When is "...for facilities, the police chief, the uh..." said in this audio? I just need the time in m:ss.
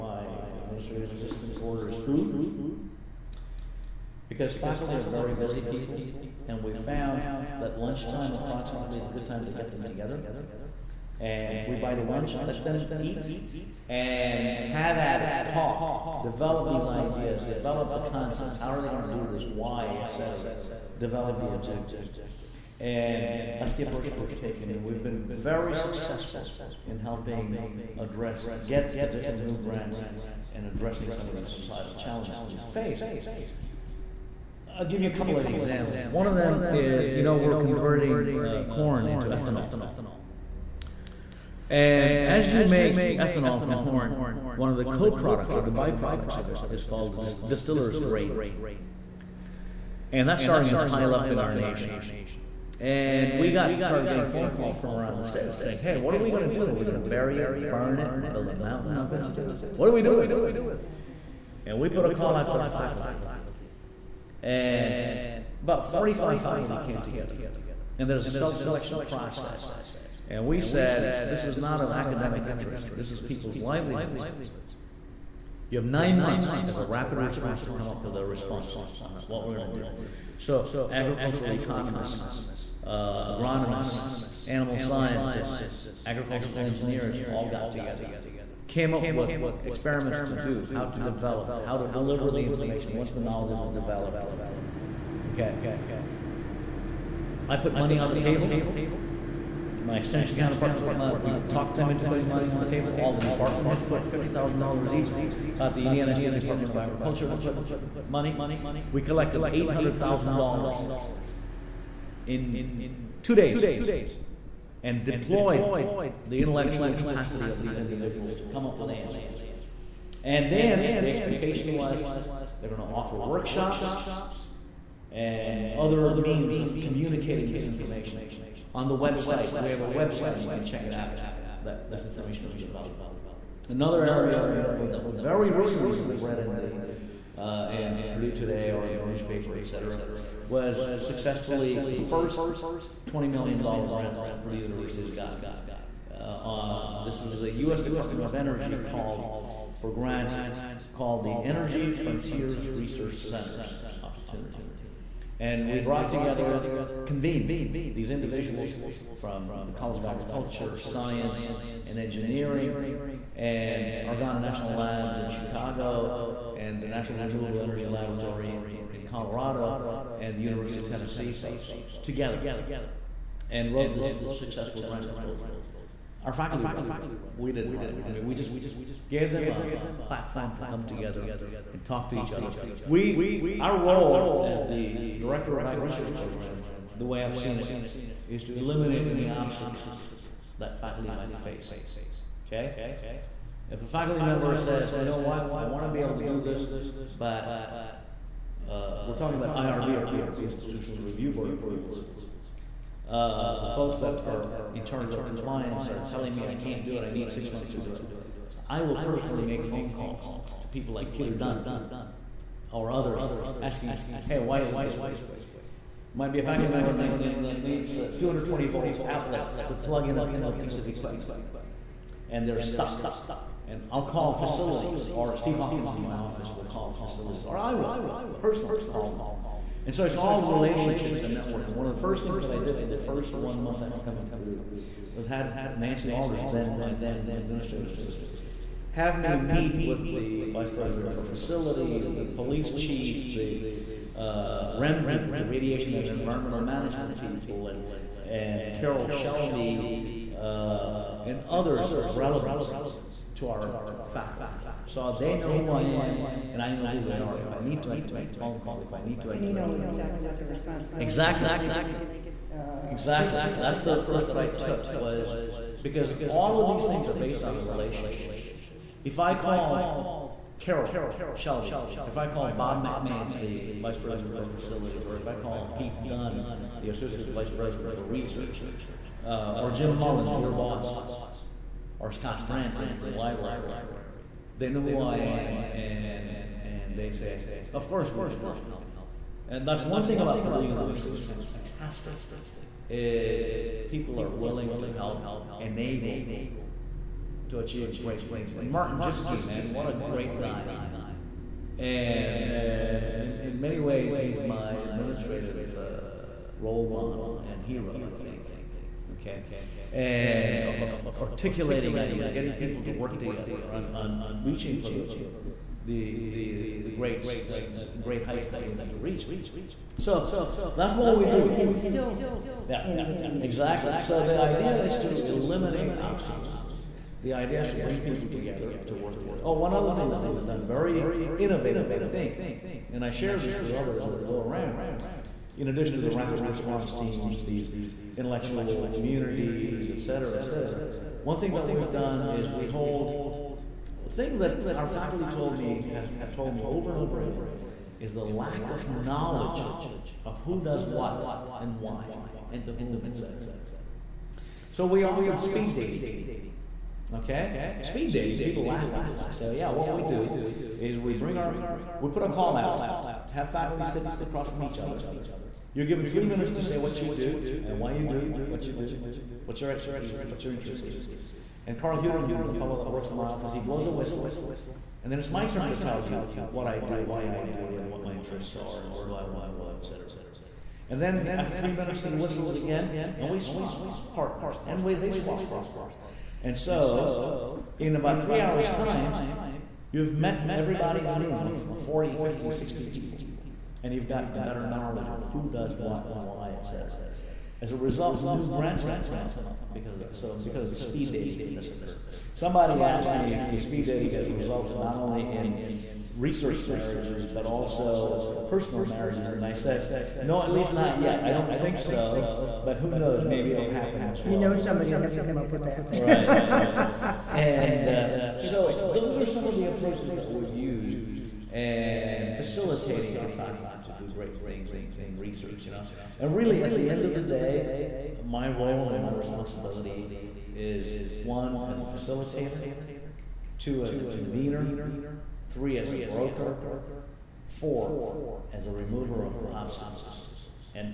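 4:01.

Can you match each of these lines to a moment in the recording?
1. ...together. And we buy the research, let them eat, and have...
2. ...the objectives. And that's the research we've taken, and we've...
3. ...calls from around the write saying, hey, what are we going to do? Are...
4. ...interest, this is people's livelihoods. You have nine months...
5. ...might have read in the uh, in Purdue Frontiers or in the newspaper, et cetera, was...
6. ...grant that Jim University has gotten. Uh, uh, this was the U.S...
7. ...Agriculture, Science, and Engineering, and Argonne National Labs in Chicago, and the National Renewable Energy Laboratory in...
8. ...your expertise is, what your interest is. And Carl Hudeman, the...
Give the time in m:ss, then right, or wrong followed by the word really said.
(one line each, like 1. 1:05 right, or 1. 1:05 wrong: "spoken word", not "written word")
1. 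0:09 wrong: "lunch", not "research"
2. 0:21 wrong: "approach", not "research"
3. 0:54 wrong: "state", not "write"
4. 1:12 right
5. 2:15 wrong: "Today", not "Frontiers"
6. 2:23 wrong: "Purdue", not "Jim"
7. 2:40 right
8. 6:09 right.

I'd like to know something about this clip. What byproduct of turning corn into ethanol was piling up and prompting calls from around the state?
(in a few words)
distiller's grain.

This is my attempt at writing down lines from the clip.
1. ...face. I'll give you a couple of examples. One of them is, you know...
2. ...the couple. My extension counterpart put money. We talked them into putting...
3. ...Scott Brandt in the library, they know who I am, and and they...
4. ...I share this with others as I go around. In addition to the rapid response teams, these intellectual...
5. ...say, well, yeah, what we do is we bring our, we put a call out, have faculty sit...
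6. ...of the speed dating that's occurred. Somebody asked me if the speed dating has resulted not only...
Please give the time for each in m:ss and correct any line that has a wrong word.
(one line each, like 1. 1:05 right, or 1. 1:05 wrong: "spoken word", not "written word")
1. 0:32 right
2. 1:38 wrong: "table", not "couple"
3. 4:42 right
4. 5:33 right
5. 5:59 right
6. 6:40 right.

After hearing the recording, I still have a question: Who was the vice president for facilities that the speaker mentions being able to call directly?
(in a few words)
Bob McMains.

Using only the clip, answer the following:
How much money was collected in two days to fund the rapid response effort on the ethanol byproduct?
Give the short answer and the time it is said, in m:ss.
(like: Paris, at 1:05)
$800,000, at 1:49.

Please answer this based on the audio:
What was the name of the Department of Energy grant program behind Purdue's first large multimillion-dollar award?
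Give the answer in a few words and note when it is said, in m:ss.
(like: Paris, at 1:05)
Energy Frontiers Research Centers, at 2:31.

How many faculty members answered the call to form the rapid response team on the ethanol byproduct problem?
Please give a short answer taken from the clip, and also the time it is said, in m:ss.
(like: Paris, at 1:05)
45, at 1:05.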